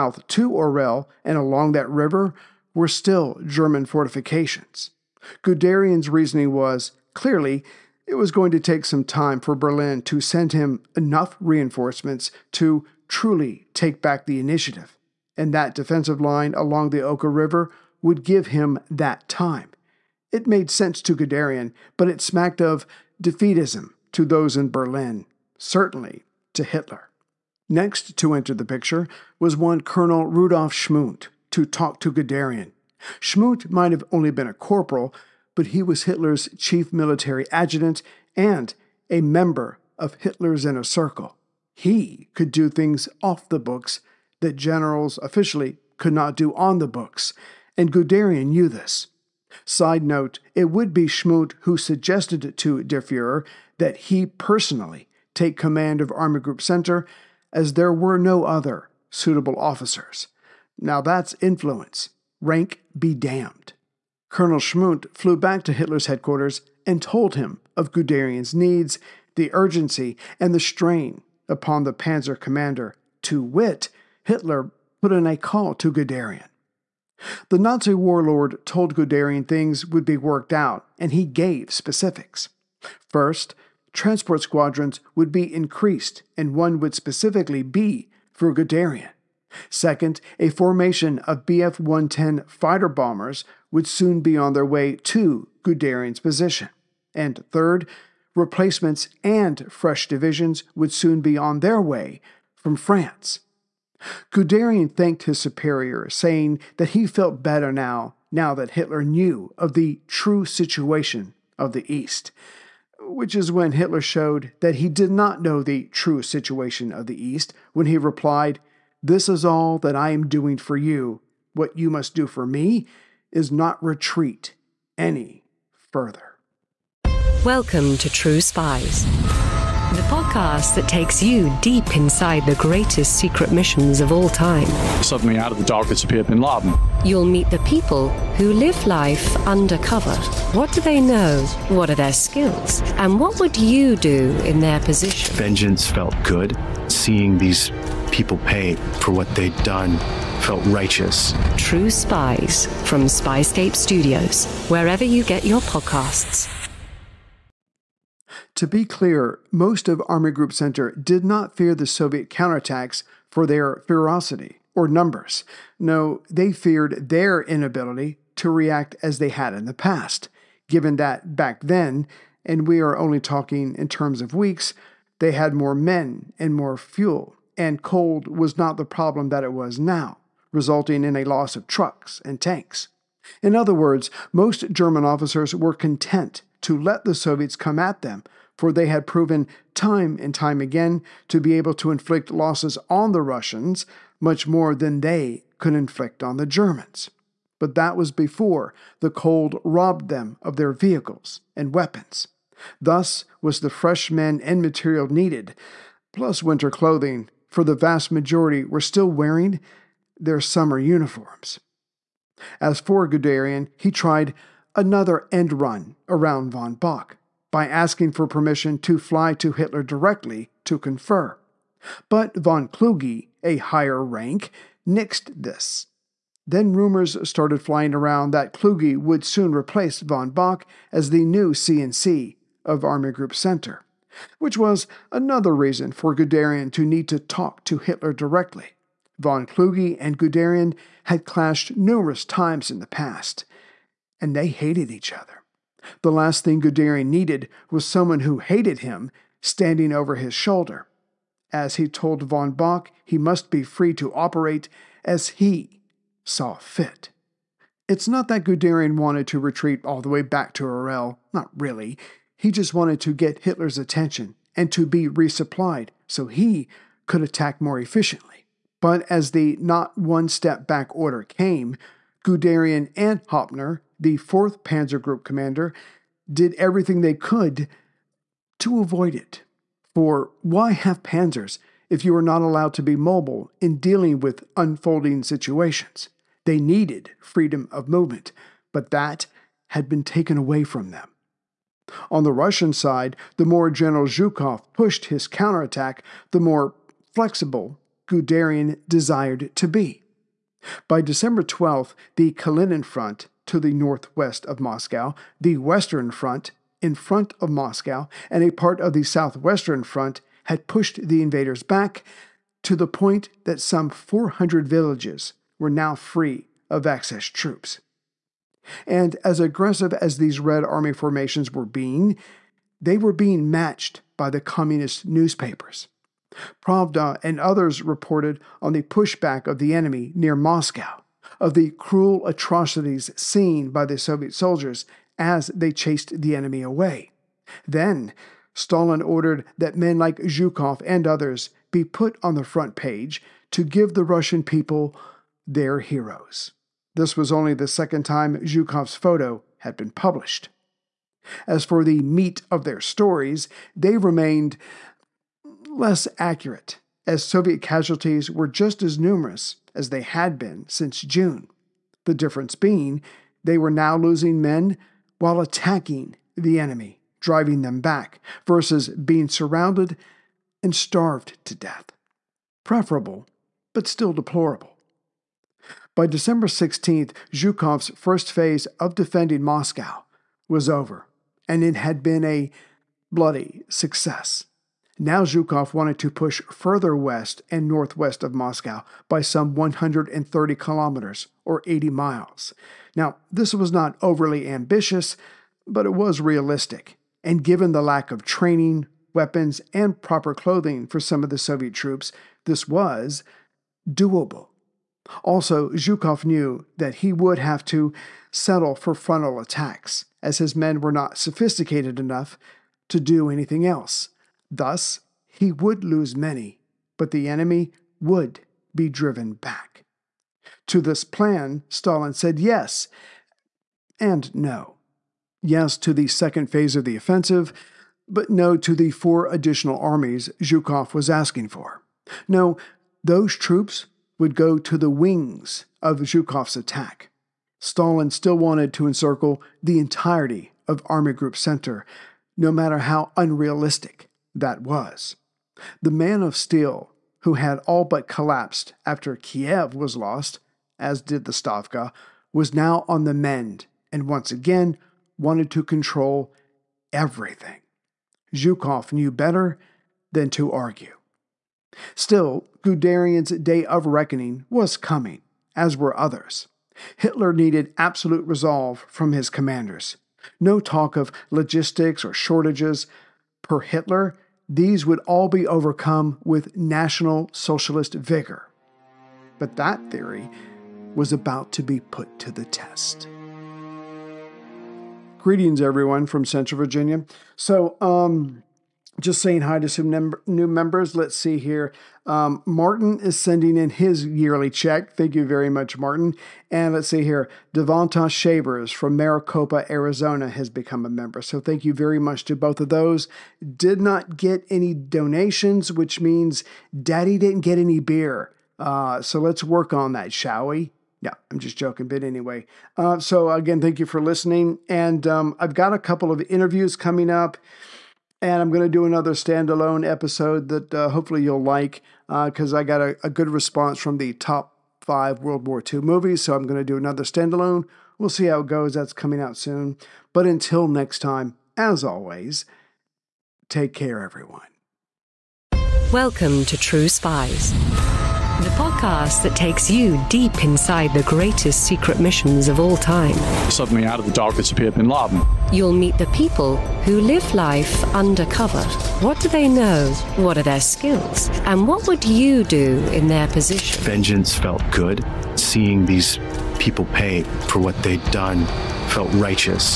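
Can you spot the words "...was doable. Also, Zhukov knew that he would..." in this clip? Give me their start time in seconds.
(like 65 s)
402 s.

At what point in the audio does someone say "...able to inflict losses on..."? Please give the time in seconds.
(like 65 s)
191 s.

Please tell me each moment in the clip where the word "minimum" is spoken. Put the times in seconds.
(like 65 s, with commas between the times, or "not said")
not said.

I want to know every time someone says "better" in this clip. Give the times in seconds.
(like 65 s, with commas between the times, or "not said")
107 s, 459 s.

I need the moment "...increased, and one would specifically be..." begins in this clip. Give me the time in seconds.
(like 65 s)
85 s.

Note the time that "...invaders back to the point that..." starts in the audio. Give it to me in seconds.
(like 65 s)
311 s.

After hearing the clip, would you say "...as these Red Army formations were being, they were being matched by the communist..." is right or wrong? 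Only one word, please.
right.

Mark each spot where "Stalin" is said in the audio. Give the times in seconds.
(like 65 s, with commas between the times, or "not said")
338 s, 421 s, 437 s.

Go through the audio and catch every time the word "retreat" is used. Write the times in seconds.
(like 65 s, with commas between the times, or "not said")
123 s, 259 s.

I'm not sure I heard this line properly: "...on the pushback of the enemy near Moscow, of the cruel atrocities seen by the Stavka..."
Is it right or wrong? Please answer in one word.
wrong.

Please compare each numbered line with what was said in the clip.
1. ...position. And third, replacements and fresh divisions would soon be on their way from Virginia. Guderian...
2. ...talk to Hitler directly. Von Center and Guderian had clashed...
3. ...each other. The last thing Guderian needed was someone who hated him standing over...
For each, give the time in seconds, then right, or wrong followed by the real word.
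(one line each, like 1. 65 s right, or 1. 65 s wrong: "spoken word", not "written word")
1. 96 s wrong: "France", not "Virginia"
2. 237 s wrong: "Kluge", not "Center"
3. 244 s right.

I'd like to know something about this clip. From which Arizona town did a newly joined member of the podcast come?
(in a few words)
Maricopa.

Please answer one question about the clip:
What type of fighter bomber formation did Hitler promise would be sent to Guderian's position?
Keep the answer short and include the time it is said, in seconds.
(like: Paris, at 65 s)
Bf 110, at 91 s.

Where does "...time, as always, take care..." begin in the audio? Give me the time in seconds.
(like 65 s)
530 s.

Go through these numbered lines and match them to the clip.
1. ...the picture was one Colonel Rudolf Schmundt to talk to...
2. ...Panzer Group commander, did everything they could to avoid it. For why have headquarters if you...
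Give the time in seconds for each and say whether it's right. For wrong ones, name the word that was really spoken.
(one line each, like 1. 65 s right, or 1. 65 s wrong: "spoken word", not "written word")
1. 28 s right
2. 274 s wrong: "panzers", not "headquarters".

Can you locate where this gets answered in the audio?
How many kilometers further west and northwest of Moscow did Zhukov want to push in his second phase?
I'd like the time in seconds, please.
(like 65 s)
389 s.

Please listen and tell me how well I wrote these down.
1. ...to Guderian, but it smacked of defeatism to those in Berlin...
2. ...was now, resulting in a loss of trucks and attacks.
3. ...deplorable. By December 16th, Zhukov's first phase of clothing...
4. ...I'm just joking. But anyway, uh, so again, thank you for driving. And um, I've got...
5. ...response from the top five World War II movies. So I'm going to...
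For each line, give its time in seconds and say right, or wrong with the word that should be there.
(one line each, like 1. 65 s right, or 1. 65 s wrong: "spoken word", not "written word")
1. 21 s right
2. 179 s wrong: "tanks", not "attacks"
3. 374 s wrong: "defending", not "clothing"
4. 511 s wrong: "listening", not "driving"
5. 523 s right.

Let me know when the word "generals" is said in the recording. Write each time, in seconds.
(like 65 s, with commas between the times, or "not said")
44 s, 293 s.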